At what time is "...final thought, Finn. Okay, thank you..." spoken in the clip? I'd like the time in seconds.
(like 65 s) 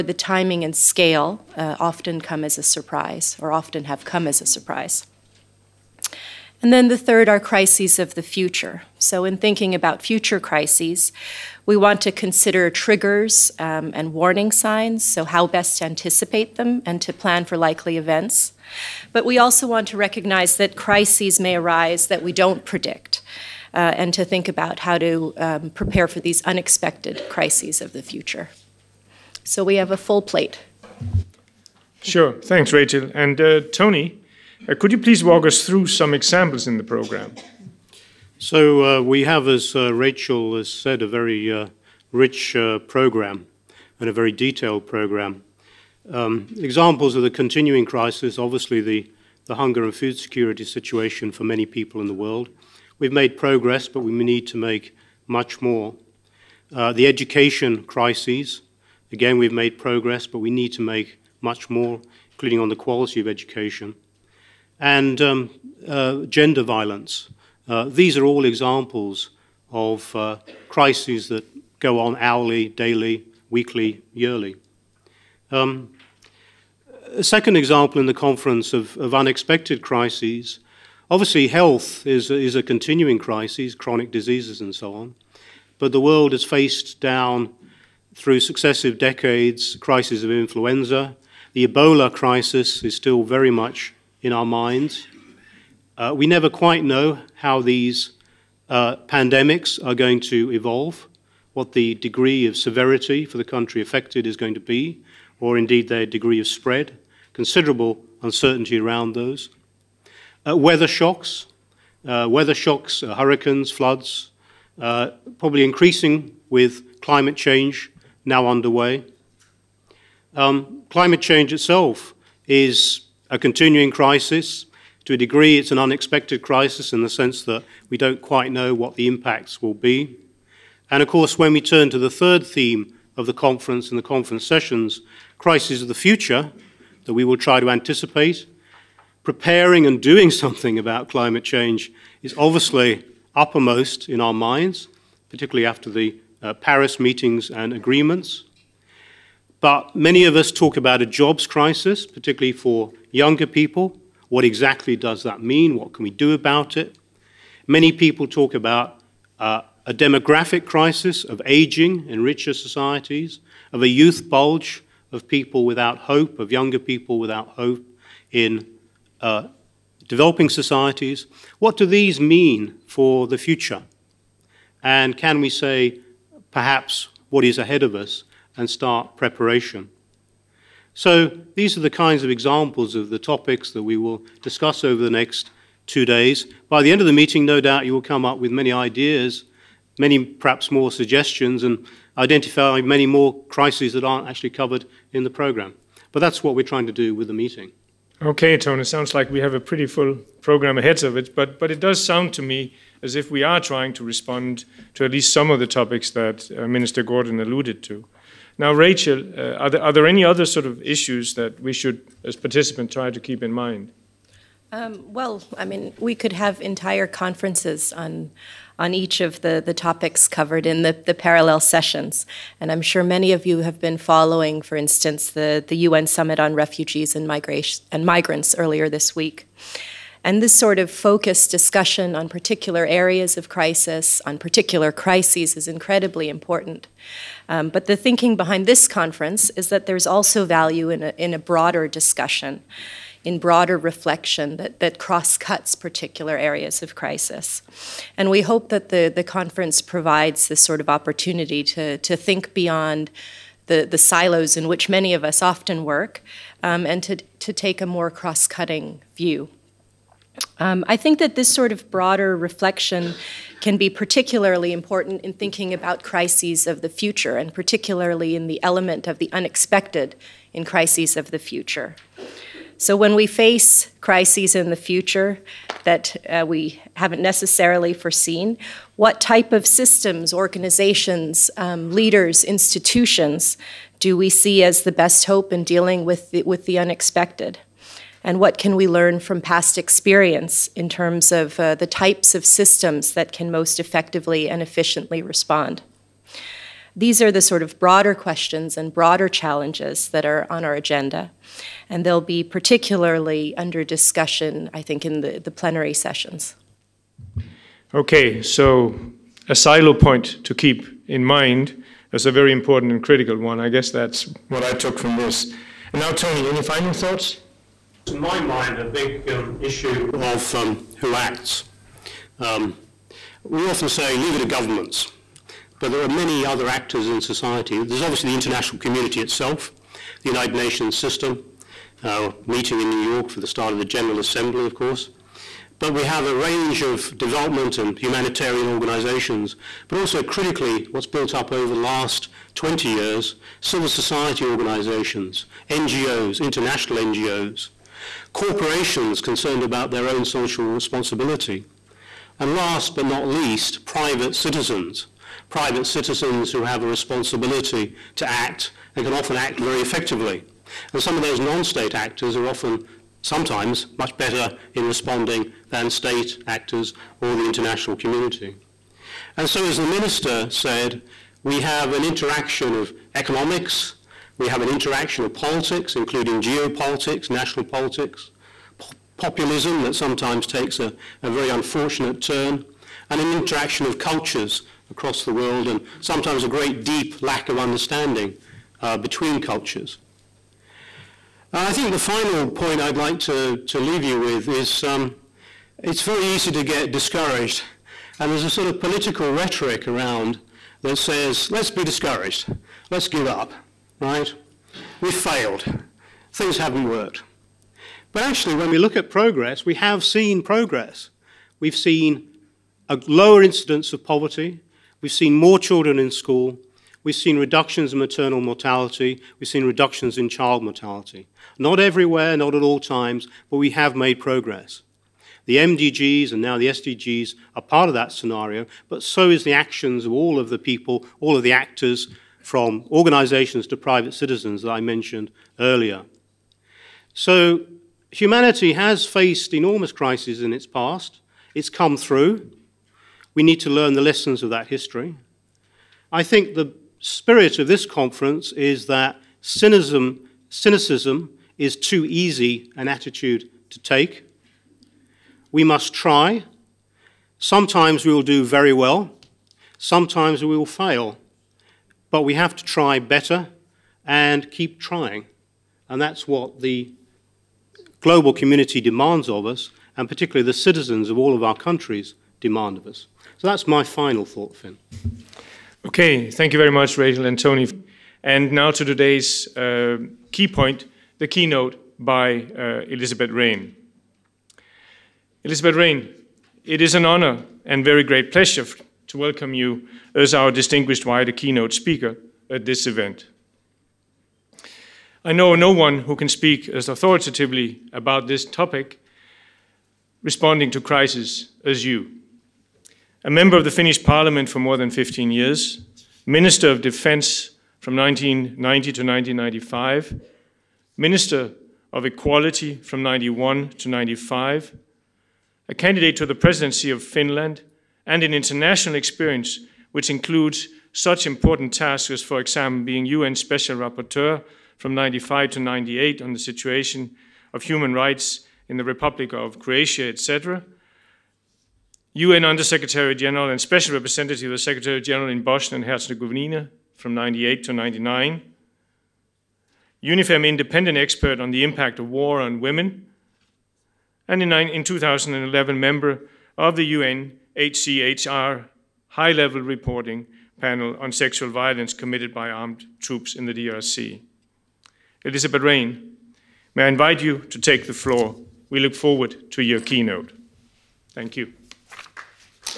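473 s.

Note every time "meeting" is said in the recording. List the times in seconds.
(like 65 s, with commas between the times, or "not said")
146 s, 187 s, 197 s, 332 s.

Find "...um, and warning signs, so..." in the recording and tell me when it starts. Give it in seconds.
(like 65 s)
13 s.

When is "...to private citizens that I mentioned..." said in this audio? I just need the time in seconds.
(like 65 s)
433 s.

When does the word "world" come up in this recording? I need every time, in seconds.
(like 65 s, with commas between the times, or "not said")
52 s, 86 s, 385 s.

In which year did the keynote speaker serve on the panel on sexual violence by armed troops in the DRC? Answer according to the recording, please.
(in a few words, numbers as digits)
2011.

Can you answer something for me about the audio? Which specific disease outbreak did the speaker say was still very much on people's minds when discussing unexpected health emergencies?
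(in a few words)
Ebola.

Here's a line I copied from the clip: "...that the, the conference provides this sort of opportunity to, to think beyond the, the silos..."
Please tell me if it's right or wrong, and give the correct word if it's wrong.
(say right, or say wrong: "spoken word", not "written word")
right.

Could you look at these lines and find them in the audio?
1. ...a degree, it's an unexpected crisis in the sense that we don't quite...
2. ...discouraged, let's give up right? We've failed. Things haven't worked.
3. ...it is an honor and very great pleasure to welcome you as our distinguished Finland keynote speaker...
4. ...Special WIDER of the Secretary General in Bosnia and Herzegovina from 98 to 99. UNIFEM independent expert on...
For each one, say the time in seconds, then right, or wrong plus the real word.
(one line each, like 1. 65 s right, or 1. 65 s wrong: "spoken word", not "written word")
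1. 125 s right
2. 401 s right
3. 486 s wrong: "WIDER", not "Finland"
4. 533 s wrong: "Representative", not "WIDER".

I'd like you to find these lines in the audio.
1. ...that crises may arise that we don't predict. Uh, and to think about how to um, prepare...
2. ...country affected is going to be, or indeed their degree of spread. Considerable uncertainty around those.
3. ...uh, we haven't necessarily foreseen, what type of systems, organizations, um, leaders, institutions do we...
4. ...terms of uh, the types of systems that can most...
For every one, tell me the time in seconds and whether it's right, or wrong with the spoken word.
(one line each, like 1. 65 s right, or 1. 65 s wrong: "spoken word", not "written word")
1. 20 s right
2. 103 s right
3. 276 s right
4. 290 s right.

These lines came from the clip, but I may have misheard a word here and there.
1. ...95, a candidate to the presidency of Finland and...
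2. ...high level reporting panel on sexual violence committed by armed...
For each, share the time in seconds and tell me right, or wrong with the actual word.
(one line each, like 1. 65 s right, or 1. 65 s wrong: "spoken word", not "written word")
1. 513 s right
2. 549 s right.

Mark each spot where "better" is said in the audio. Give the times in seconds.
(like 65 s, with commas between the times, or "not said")
364 s, 462 s.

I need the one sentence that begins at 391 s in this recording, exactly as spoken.
And I think the final point I'd like to, to leave you with is um, it's very easy to get discouraged.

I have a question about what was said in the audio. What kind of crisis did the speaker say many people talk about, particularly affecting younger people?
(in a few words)
A jobs crisis.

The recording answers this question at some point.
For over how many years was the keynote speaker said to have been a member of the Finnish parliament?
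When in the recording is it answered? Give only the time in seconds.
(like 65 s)
504 s.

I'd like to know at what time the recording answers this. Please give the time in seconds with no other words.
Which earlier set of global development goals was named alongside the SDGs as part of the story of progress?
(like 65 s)
425 s.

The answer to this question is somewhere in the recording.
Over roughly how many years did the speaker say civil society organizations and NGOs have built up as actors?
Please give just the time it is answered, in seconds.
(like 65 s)
342 s.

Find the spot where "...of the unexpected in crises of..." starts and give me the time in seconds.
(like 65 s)
269 s.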